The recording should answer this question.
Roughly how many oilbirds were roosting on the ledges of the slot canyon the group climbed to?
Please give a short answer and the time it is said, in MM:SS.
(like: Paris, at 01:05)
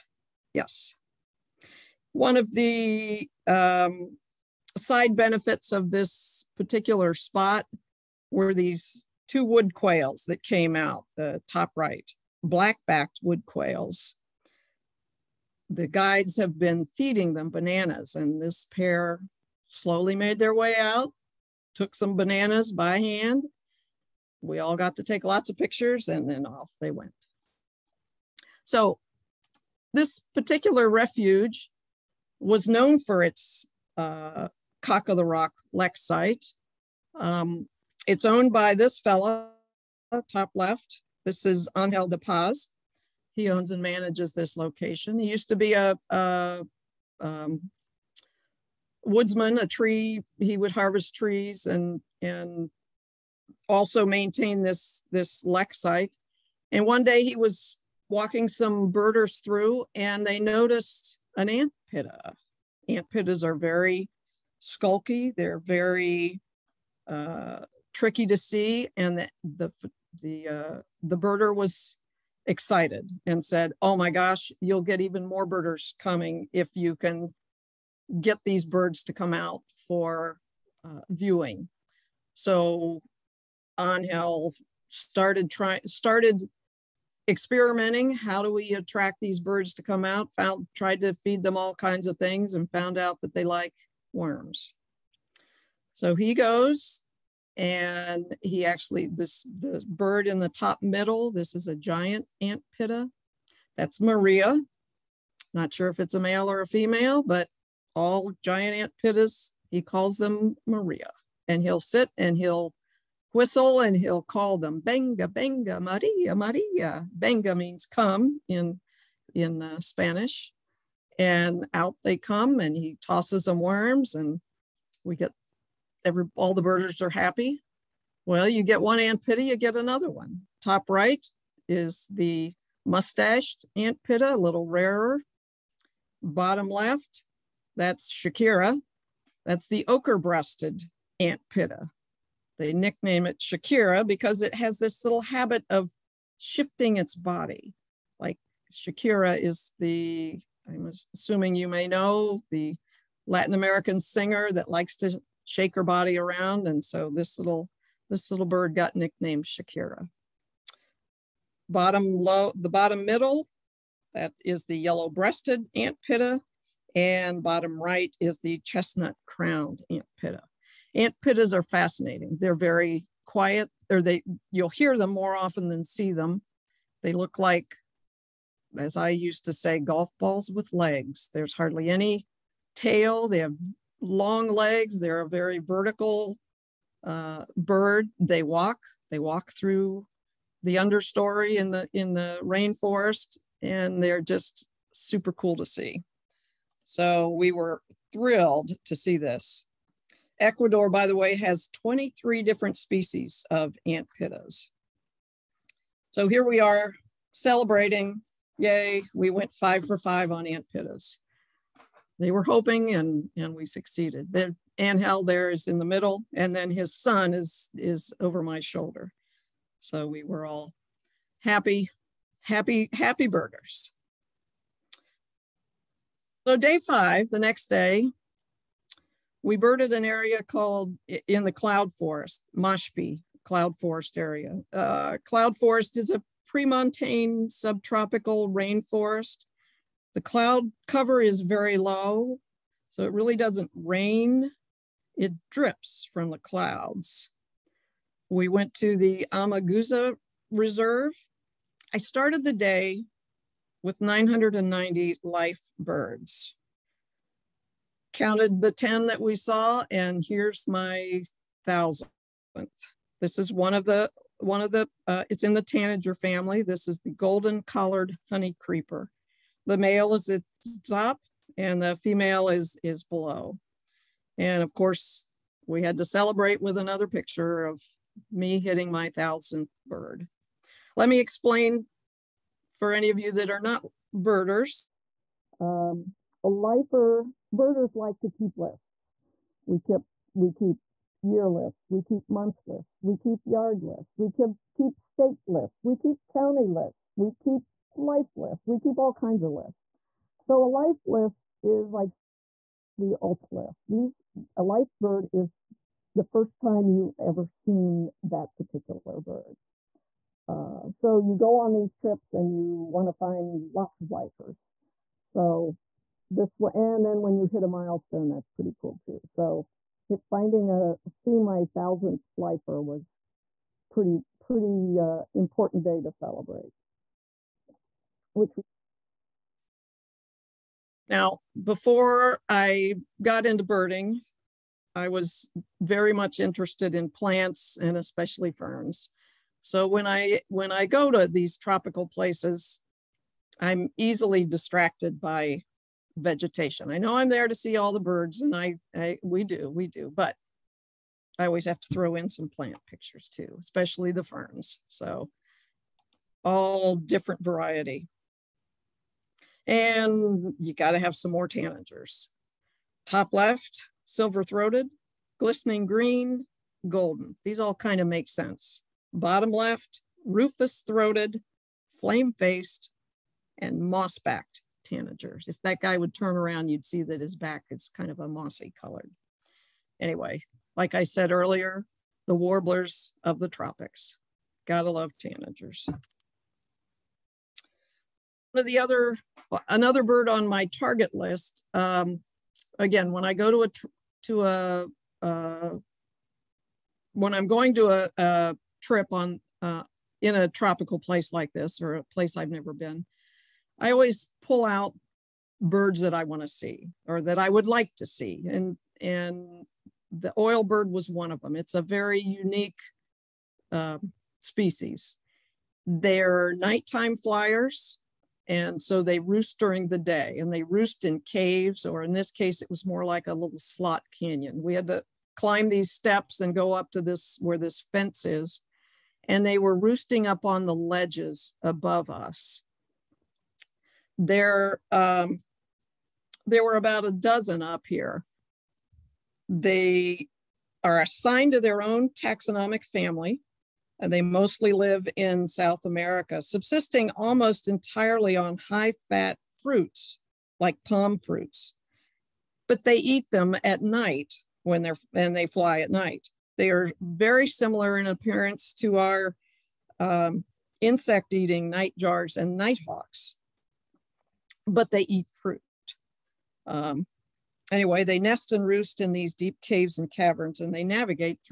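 About a dozen, at 07:16.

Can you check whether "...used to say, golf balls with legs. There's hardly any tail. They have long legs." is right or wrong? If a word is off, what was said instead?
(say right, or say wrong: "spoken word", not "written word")
right.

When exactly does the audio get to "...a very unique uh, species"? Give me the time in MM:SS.
06:51.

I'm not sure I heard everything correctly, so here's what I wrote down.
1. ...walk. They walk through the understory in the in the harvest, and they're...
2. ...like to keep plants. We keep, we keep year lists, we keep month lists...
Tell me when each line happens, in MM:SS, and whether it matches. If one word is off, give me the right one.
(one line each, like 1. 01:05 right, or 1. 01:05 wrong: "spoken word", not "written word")
1. 03:08 wrong: "rainforest", not "harvest"
2. 04:47 wrong: "lists", not "plants".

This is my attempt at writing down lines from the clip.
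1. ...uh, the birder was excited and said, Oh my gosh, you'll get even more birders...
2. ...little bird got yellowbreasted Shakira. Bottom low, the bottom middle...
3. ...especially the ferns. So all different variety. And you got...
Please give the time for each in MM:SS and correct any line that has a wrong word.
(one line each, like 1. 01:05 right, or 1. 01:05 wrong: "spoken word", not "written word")
1. 01:10 right
2. 02:38 wrong: "nicknamed", not "yellowbreasted"
3. 05:53 right.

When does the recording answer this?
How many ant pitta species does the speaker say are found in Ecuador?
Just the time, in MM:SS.
03:21.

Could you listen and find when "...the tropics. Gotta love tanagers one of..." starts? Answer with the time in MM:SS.
06:23.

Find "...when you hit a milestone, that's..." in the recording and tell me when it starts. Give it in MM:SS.
05:17.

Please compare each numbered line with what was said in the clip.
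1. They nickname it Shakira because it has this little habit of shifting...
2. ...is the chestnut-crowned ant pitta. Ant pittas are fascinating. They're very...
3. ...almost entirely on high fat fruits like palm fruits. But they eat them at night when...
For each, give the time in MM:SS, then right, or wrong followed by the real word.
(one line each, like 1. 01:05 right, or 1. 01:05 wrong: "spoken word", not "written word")
1. 02:22 right
2. 02:48 right
3. 07:27 right.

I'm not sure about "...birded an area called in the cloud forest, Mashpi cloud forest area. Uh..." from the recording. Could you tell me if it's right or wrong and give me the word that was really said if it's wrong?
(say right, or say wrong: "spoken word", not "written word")
right.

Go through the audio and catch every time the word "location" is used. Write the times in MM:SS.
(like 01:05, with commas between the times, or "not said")
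00:44.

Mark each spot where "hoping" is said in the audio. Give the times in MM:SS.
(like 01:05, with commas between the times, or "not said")
03:32.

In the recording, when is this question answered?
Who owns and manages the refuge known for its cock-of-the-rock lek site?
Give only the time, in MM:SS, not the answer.
00:41.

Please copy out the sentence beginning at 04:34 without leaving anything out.
And of course, we had to celebrate with another picture of me hitting my thousandth bird.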